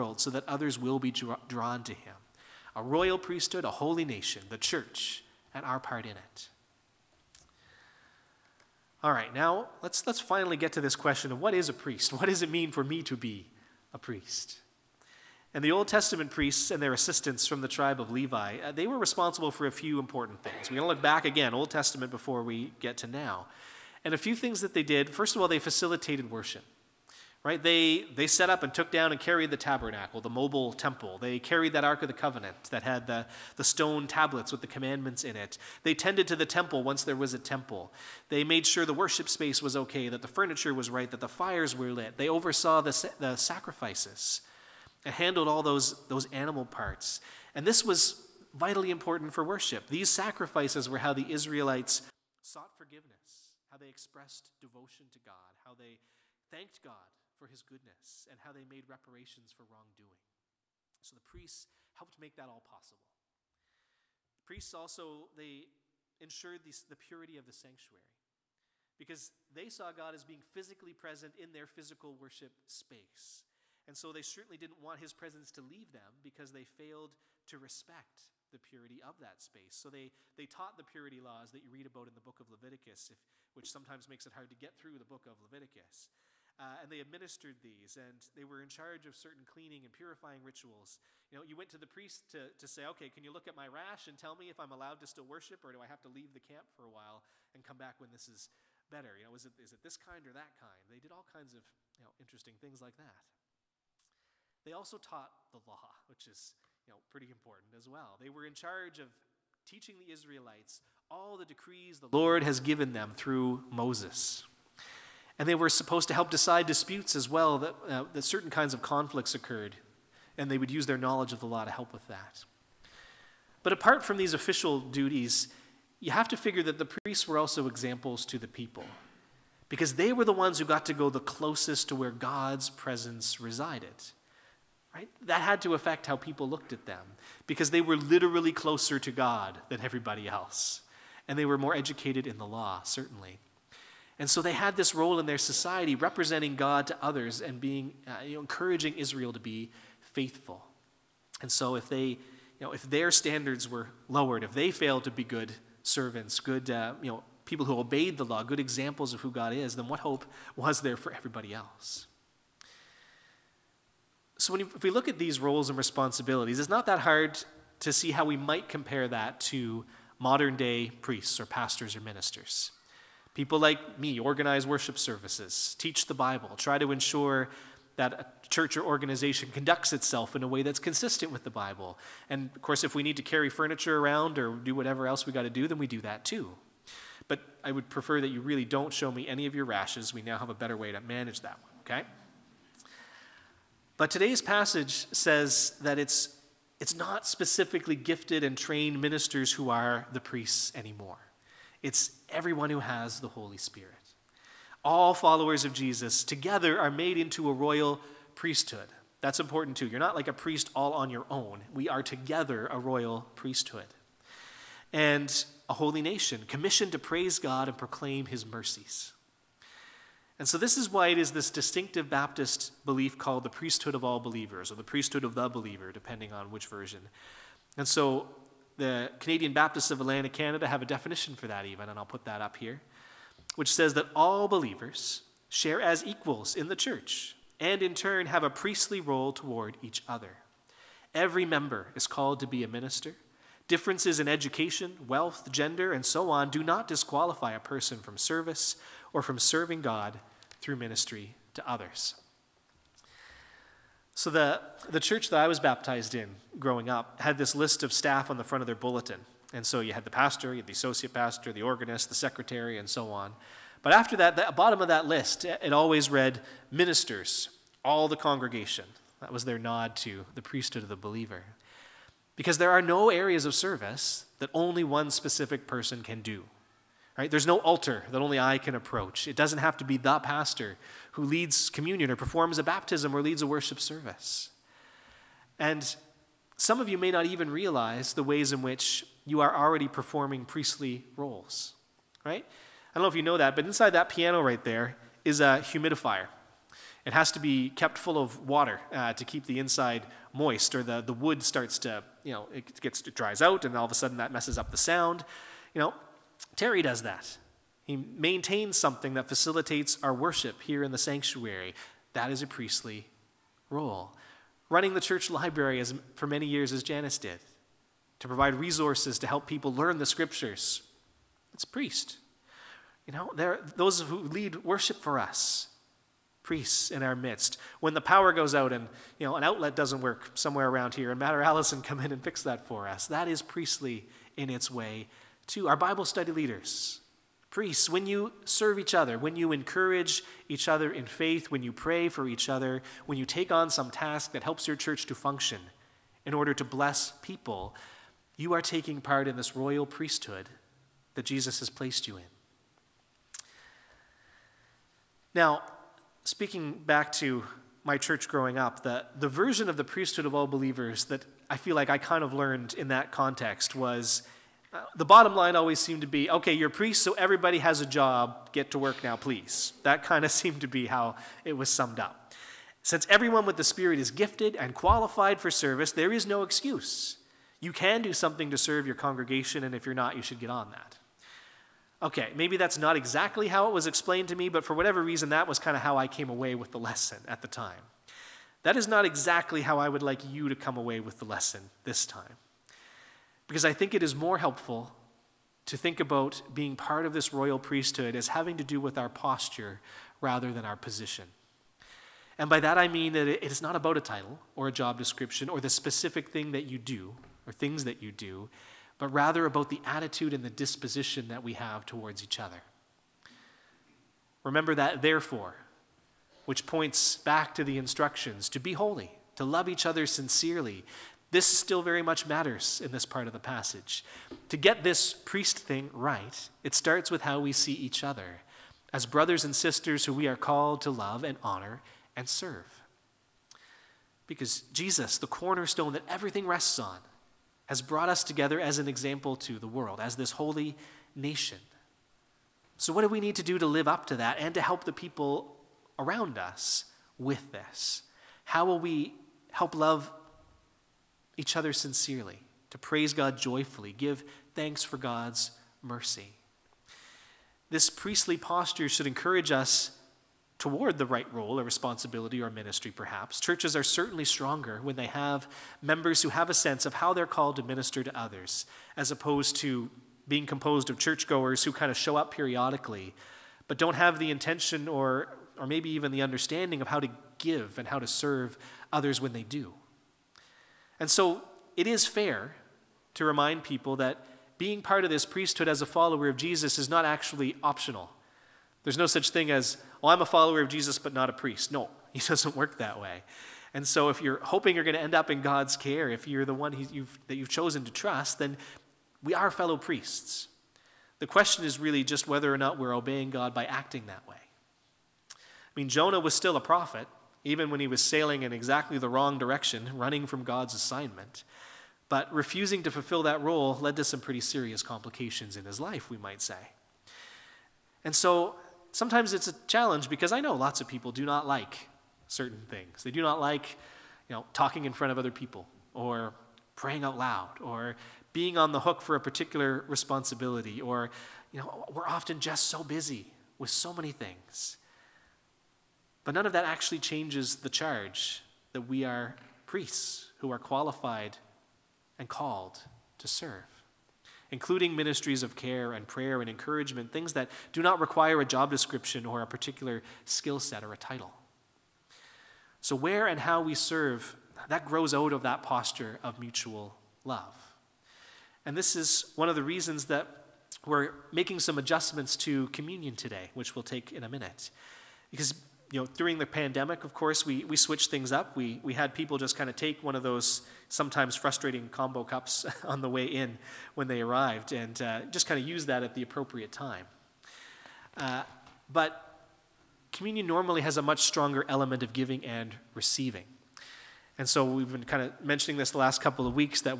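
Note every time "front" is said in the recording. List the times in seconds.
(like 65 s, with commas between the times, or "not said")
258 s, 524 s.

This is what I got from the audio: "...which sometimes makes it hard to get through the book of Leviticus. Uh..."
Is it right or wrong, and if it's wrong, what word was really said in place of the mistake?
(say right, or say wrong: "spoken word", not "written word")
right.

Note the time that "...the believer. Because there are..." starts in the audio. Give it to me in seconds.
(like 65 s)
270 s.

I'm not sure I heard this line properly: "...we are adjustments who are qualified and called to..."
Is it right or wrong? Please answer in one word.
wrong.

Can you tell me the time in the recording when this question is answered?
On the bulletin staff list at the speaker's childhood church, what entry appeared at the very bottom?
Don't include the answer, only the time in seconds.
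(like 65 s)
266 s.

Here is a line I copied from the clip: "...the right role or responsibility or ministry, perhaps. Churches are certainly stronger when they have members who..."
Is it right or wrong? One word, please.
right.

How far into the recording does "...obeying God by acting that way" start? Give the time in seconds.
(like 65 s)
502 s.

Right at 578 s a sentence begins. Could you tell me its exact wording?
Uh, but communion normally has a much stronger element of giving and receiving.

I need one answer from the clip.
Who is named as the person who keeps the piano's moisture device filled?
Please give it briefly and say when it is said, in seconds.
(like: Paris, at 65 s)
Terry, at 306 s.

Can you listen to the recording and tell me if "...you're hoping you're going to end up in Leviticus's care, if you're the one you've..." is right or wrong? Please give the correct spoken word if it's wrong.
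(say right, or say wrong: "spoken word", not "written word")
wrong: "God", not "Leviticus".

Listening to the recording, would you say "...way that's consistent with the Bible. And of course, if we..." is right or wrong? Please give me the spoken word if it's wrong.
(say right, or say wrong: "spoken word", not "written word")
right.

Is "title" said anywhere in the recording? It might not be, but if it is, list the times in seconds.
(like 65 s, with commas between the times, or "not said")
403 s, 550 s.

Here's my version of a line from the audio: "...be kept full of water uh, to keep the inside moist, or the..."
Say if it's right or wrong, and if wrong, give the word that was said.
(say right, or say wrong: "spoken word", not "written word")
right.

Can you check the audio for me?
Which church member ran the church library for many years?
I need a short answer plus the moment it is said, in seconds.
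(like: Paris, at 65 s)
Janice, at 316 s.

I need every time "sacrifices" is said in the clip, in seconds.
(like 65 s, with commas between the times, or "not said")
43 s, 50 s.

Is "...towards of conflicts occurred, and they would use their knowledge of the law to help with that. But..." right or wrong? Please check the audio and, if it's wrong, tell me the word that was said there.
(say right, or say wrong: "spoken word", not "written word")
wrong: "kinds", not "towards".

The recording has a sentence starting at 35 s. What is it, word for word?
They tended to the temple once there was a temple.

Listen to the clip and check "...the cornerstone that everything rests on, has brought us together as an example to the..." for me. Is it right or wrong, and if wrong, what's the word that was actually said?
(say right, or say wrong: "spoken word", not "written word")
right.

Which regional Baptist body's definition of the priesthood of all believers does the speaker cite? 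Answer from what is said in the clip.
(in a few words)
Canadian Baptists of Atlantic Canada.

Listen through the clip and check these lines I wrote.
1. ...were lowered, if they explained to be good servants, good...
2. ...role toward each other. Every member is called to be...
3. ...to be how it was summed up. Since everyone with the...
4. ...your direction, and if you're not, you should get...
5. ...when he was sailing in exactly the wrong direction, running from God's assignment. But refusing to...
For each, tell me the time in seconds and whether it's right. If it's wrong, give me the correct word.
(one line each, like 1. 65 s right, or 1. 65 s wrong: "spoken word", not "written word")
1. 153 s wrong: "failed", not "explained"
2. 239 s right
3. 370 s right
4. 378 s wrong: "congregation", not "direction"
5. 507 s right.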